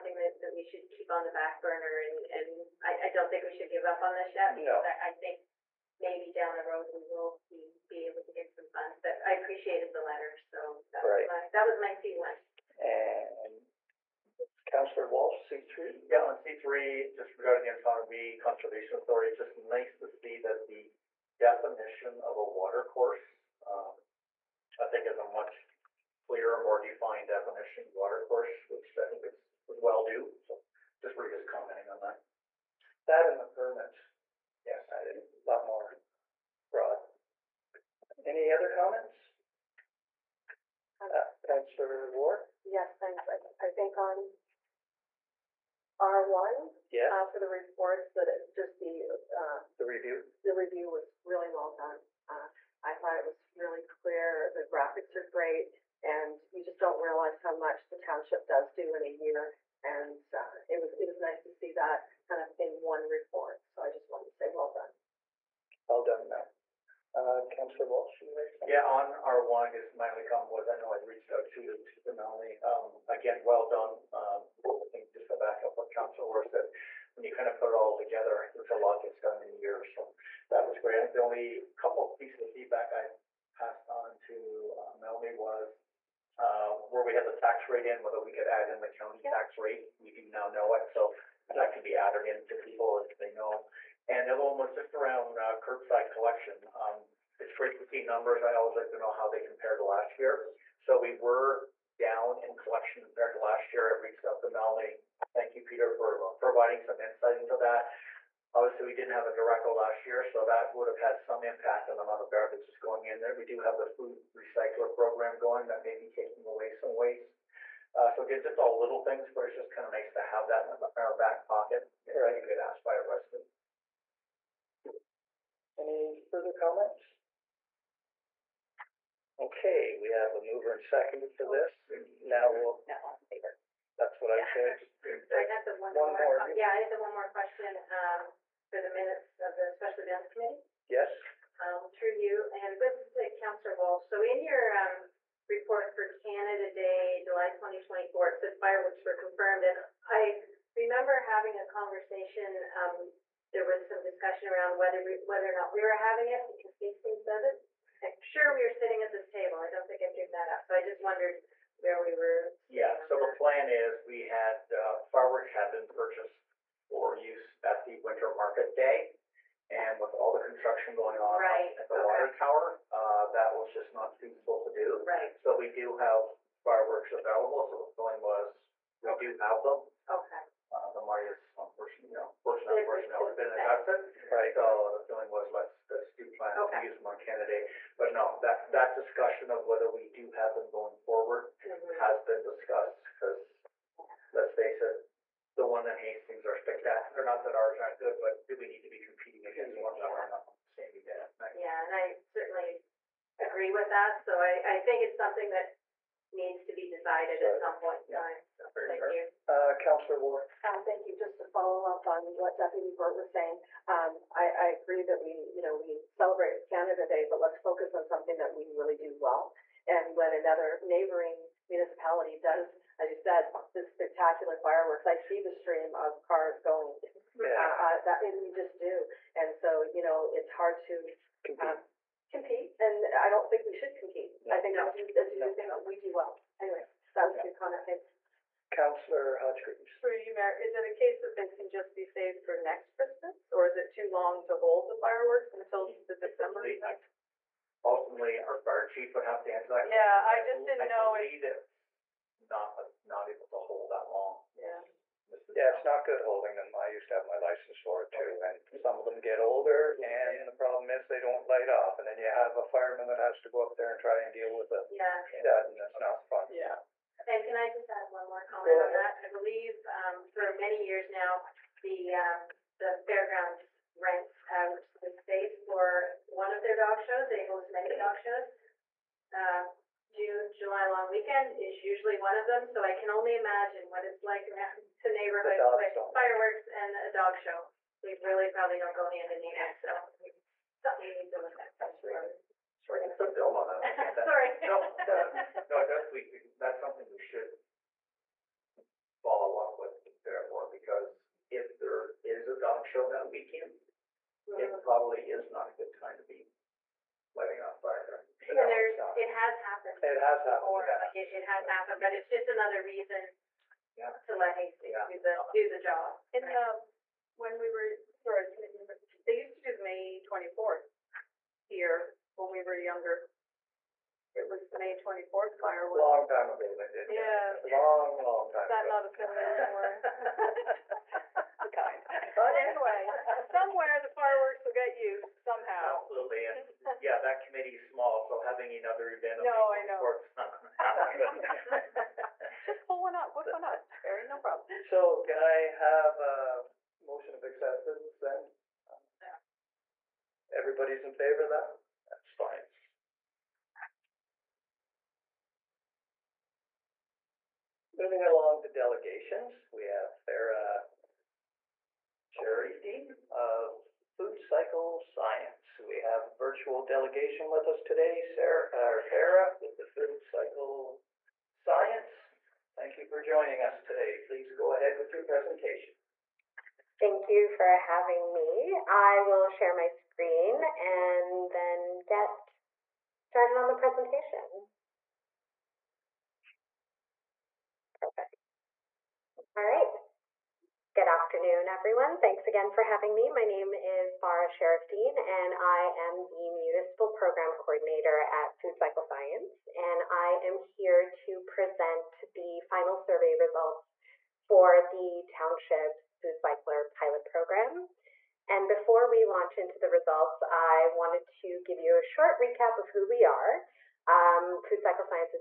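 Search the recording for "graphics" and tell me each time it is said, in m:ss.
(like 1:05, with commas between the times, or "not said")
0:54.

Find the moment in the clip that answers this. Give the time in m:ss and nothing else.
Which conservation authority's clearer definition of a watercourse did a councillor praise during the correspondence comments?
0:17.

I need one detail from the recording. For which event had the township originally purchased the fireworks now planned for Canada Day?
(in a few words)
winter market day.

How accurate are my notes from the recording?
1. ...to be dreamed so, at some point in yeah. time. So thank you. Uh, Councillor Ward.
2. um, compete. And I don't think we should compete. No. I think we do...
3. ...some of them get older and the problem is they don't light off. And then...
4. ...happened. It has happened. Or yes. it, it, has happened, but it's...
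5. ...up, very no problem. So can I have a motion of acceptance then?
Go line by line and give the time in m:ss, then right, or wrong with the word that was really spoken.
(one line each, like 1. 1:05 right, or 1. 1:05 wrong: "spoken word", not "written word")
1. 3:26 wrong: "decided", not "dreamed"
2. 3:51 right
3. 4:18 right
4. 5:09 right
5. 5:43 right.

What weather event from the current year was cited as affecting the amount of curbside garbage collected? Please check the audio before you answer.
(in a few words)
a derecho.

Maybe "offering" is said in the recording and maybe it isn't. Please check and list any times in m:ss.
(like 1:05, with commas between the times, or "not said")
not said.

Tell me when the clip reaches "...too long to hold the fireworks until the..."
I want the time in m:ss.
4:03.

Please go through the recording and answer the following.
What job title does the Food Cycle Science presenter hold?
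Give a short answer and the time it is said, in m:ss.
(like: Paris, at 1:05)
Municipal Program Coordinator, at 6:36.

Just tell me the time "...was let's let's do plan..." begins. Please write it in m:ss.
3:05.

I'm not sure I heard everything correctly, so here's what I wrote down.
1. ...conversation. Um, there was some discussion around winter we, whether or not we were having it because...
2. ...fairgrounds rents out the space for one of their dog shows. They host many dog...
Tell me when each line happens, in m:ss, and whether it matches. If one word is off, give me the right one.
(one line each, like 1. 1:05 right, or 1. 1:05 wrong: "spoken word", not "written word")
1. 2:31 wrong: "whether", not "winter"
2. 4:33 right.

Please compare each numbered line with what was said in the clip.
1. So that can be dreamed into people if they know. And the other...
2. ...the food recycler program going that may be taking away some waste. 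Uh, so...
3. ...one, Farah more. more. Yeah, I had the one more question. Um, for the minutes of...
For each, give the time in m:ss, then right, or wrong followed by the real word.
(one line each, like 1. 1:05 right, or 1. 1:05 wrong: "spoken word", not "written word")
1. 1:30 wrong: "added", not "dreamed"
2. 1:53 right
3. 2:15 wrong: "One", not "Farah".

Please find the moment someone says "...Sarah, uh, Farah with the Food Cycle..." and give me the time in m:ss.
6:08.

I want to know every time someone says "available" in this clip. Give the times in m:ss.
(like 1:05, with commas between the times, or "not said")
2:57.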